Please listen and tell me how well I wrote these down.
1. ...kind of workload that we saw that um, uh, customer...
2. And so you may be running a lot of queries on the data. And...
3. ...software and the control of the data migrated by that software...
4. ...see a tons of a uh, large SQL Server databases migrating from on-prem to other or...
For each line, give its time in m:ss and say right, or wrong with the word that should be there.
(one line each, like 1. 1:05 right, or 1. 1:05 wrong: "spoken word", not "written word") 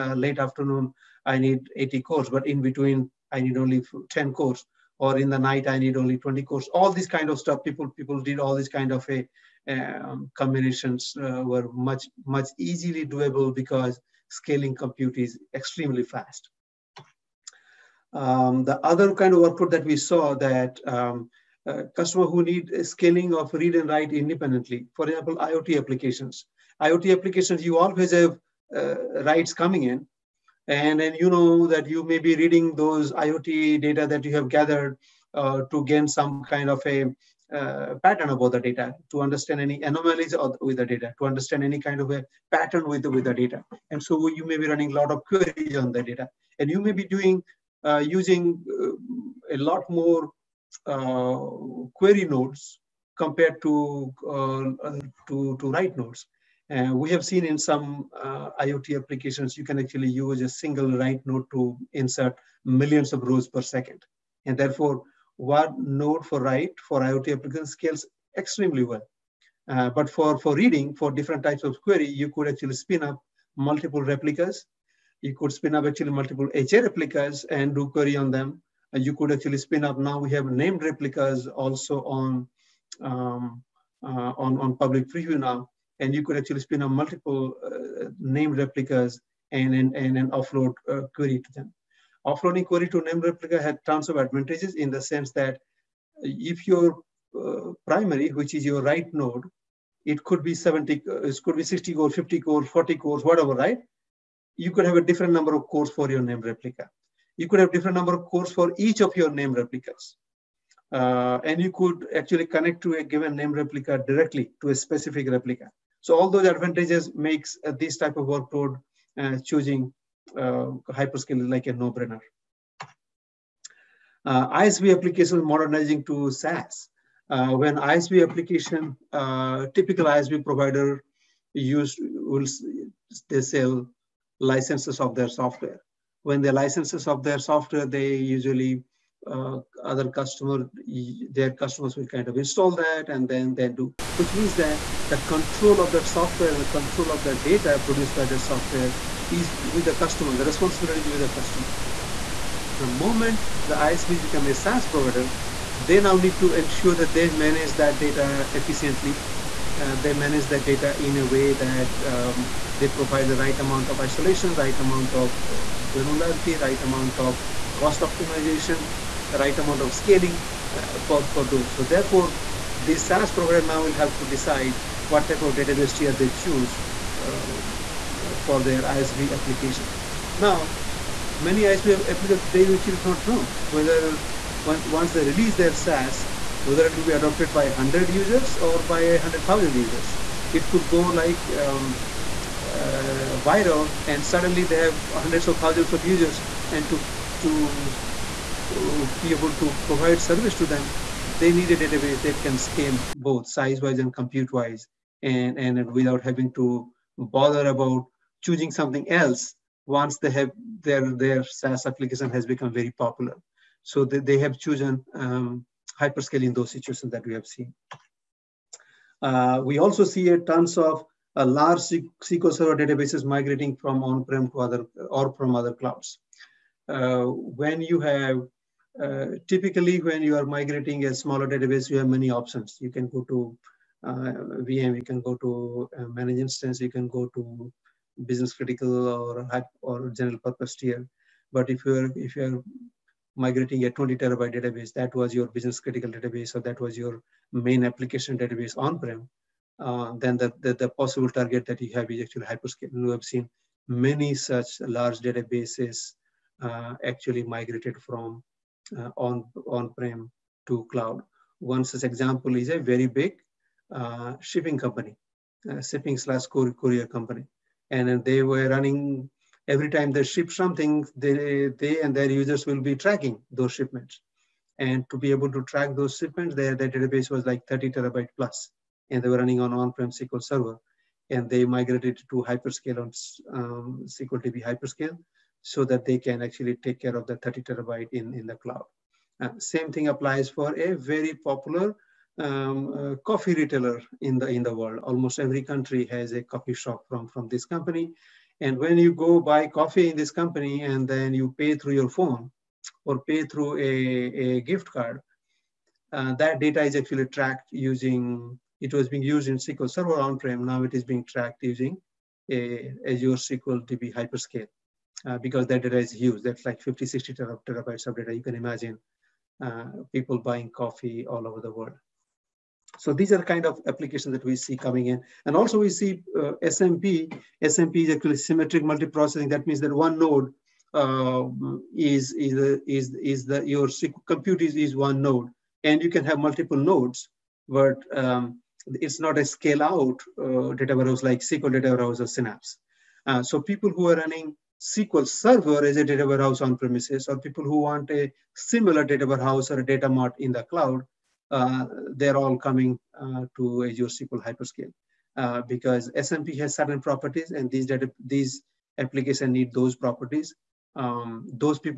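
1. 0:19 right
2. 0:43 right
3. 2:26 wrong: "produced", not "migrated"
4. 3:40 right.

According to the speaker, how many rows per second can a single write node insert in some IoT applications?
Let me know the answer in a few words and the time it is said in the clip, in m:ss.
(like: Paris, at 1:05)
Millions, at 1:02.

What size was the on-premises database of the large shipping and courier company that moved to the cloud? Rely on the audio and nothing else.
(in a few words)
30 terabytes plus.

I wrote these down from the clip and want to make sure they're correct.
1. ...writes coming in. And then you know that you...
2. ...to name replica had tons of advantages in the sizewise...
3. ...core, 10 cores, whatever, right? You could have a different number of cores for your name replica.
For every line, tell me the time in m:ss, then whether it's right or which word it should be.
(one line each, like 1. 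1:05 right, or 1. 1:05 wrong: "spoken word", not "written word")
1. 0:29 right
2. 1:32 wrong: "sense", not "sizewise"
3. 1:42 wrong: "40", not "10".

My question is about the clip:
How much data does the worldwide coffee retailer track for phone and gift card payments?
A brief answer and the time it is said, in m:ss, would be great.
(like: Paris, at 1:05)
50 to 60 terabytes, at 5:16.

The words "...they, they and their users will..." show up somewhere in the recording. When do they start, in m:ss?
4:31.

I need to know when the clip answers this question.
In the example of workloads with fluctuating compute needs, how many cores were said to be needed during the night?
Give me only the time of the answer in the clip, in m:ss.
0:06.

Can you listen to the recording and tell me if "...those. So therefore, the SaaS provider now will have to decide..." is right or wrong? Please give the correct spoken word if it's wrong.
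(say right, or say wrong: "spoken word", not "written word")
right.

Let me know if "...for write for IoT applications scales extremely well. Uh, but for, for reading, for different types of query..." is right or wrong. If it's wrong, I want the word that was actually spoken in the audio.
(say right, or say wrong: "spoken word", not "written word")
right.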